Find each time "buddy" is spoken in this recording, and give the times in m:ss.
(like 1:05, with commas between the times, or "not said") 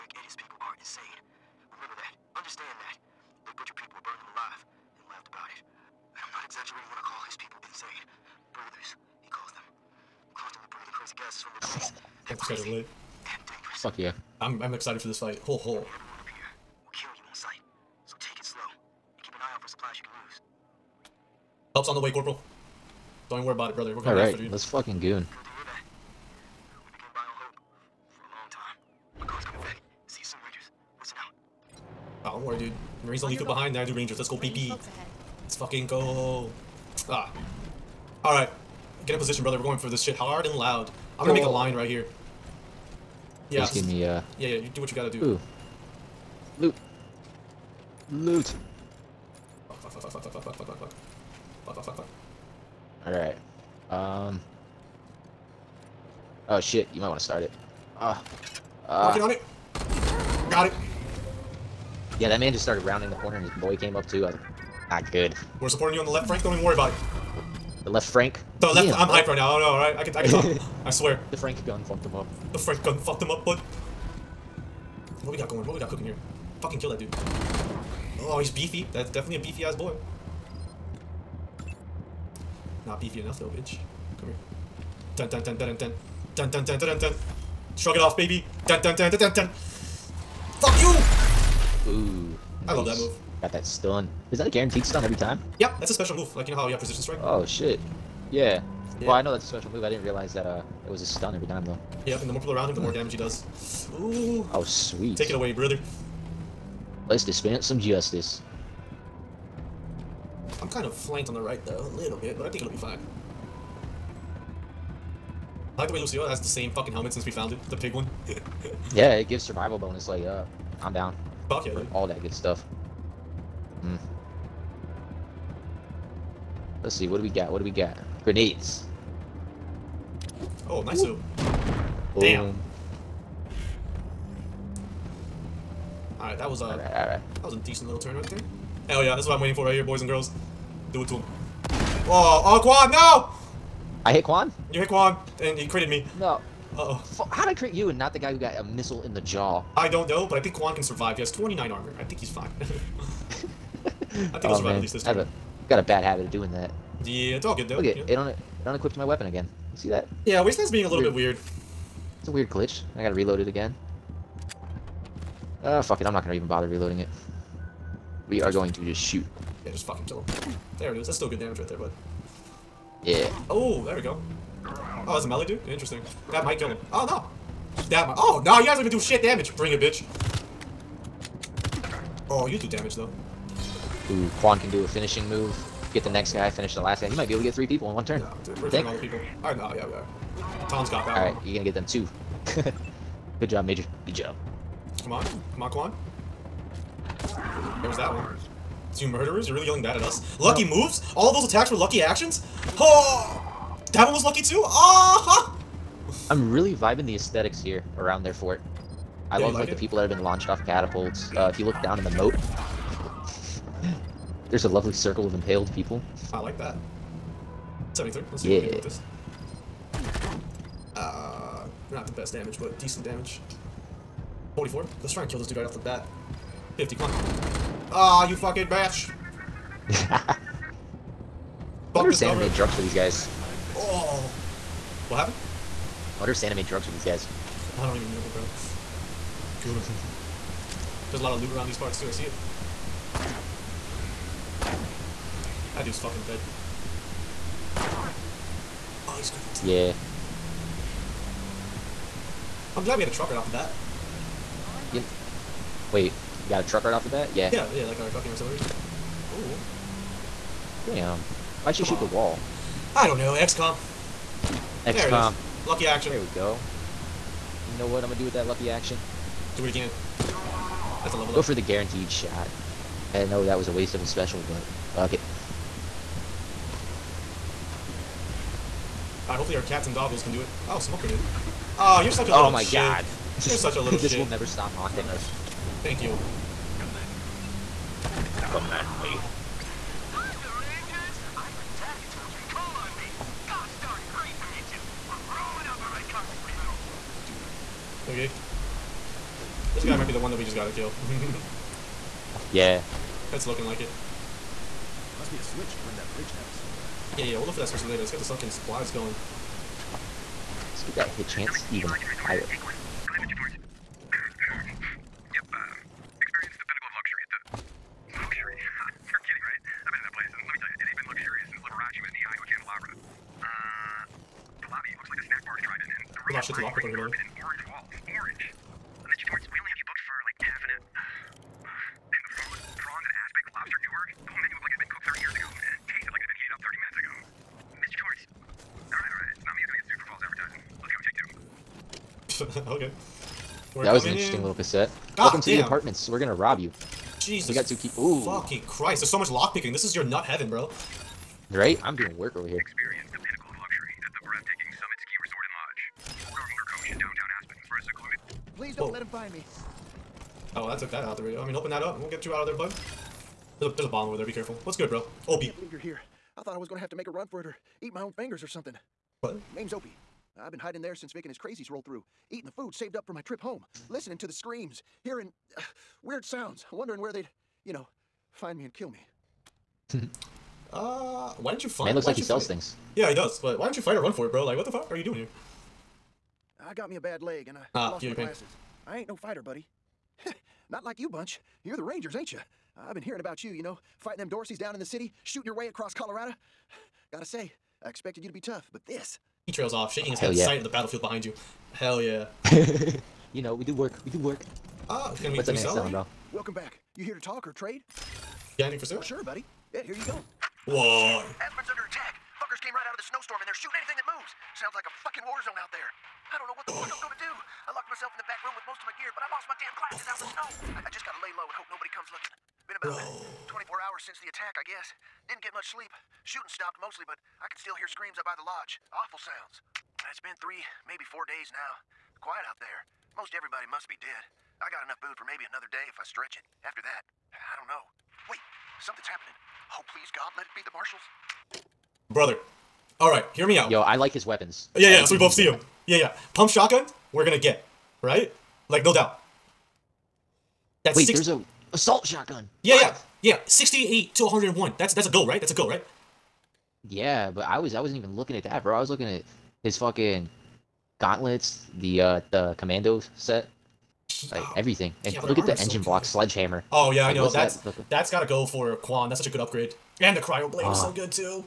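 6:29, 6:49.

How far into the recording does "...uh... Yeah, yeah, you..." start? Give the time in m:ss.
0:44.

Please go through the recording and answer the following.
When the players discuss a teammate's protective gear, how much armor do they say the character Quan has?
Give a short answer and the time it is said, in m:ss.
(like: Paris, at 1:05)
29, at 2:31.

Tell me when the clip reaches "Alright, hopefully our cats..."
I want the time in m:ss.
4:39.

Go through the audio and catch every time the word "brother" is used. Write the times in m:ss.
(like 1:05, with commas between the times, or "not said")
0:08, 0:23, 0:39, 1:45, 7:22.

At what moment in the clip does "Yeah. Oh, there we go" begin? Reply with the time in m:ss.
2:53.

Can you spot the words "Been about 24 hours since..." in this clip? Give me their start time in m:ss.
7:02.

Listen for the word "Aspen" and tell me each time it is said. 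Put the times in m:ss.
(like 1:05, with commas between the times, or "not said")
5:57, 6:51.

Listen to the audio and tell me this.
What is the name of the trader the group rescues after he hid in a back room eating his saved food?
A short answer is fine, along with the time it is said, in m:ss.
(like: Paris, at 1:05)
Opie, at 6:09.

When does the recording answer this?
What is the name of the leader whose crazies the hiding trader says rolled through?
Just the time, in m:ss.
6:11.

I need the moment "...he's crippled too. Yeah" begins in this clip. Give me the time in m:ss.
4:09.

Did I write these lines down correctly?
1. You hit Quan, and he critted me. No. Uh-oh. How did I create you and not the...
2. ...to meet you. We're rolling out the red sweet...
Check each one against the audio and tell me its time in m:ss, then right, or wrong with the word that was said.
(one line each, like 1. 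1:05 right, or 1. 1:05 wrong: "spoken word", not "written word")
1. 2:24 right
2. 4:54 wrong: "carpet", not "sweet".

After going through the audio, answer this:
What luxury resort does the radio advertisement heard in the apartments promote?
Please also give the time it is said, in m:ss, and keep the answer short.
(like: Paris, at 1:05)
Summit Ski Resort and Lodge, at 5:54.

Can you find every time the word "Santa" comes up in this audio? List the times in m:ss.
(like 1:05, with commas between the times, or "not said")
3:52, 3:56.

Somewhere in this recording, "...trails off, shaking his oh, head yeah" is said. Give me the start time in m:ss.
6:39.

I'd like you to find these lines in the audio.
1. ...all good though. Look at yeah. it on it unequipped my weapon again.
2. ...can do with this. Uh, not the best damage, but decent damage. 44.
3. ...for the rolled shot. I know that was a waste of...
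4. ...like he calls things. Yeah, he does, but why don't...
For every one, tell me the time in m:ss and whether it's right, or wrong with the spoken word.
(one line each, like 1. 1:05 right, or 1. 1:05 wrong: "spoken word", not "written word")
1. 2:37 right
2. 3:38 right
3. 4:31 wrong: "guaranteed", not "rolled"
4. 6:22 wrong: "sells", not "calls".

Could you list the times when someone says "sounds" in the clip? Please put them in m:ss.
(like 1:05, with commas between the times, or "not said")
6:16, 6:54, 7:09.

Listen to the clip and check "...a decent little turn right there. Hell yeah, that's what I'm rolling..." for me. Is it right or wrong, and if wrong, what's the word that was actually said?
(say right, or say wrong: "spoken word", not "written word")
wrong: "waiting", not "rolling".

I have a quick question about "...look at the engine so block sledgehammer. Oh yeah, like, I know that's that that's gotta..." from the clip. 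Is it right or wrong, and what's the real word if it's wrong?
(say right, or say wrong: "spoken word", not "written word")
right.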